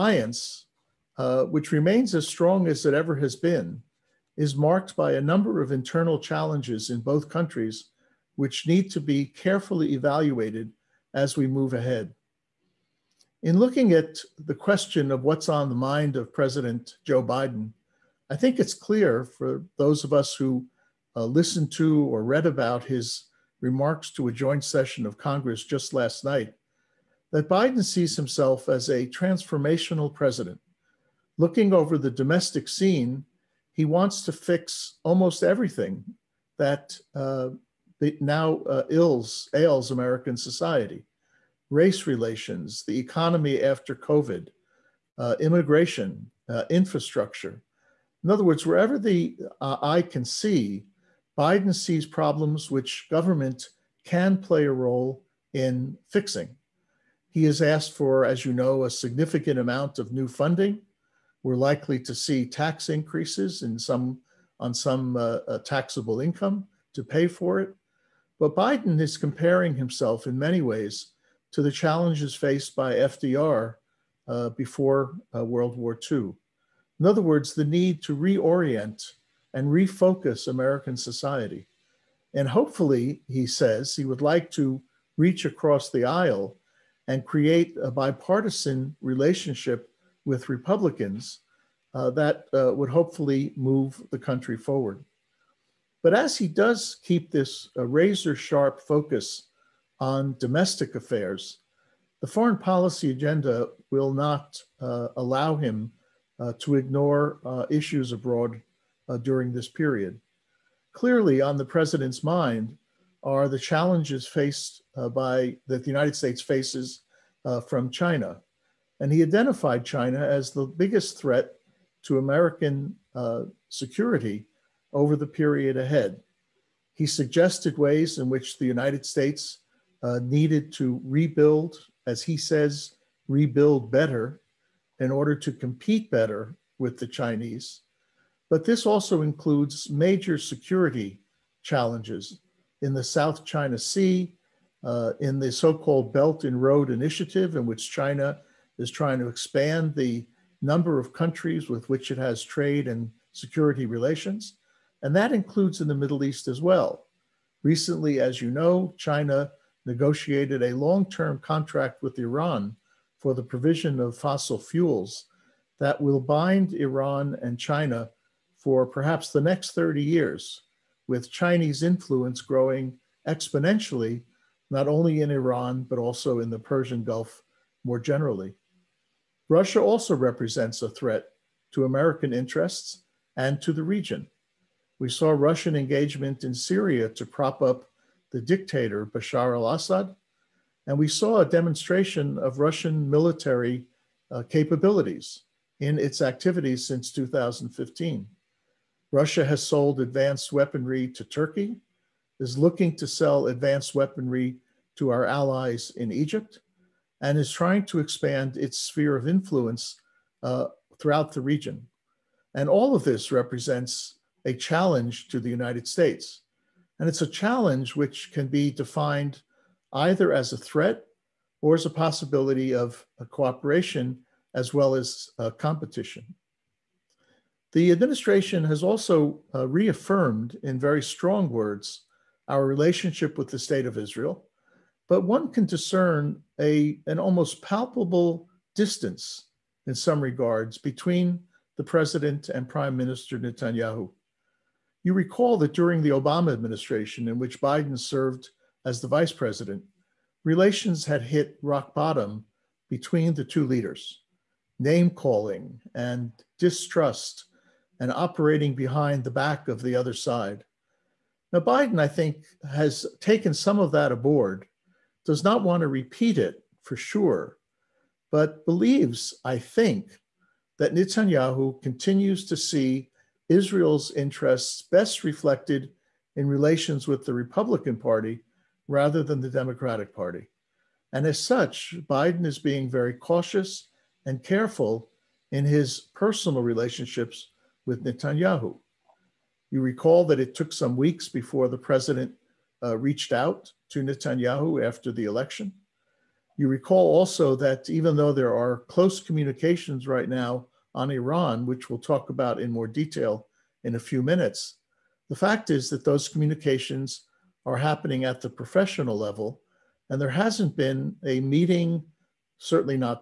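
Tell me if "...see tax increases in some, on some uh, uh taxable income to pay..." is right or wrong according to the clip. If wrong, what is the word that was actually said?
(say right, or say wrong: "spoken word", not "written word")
right.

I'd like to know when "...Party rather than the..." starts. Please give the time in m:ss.
4:37.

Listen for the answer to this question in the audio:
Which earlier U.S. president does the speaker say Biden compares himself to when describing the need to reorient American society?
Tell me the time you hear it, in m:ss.
1:12.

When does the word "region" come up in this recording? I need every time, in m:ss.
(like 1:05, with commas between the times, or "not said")
3:03, 3:31.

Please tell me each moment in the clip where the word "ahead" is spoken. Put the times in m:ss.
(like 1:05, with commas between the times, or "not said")
0:11, 2:05.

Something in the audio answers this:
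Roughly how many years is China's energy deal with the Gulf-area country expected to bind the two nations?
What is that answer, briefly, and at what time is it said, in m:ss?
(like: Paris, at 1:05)
30, at 2:49.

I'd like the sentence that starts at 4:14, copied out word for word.
Name calling and distrust and operating behind the back of the other side.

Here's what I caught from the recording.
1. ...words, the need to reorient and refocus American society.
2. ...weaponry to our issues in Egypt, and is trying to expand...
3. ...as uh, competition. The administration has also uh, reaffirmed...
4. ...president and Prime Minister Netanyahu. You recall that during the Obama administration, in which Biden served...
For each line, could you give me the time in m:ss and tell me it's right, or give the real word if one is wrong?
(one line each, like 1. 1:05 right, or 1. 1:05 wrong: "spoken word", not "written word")
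1. 1:17 right
2. 3:23 wrong: "allies", not "issues"
3. 3:44 right
4. 4:01 right.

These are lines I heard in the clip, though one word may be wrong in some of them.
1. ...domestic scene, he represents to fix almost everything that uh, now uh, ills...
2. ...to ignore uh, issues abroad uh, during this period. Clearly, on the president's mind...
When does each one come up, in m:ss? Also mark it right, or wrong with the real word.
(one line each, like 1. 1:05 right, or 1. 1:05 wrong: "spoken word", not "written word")
1. 0:32 wrong: "wants", not "represents"
2. 1:46 right.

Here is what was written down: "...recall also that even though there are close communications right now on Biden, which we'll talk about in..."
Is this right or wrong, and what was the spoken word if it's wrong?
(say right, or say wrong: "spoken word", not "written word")
wrong: "Iran", not "Biden".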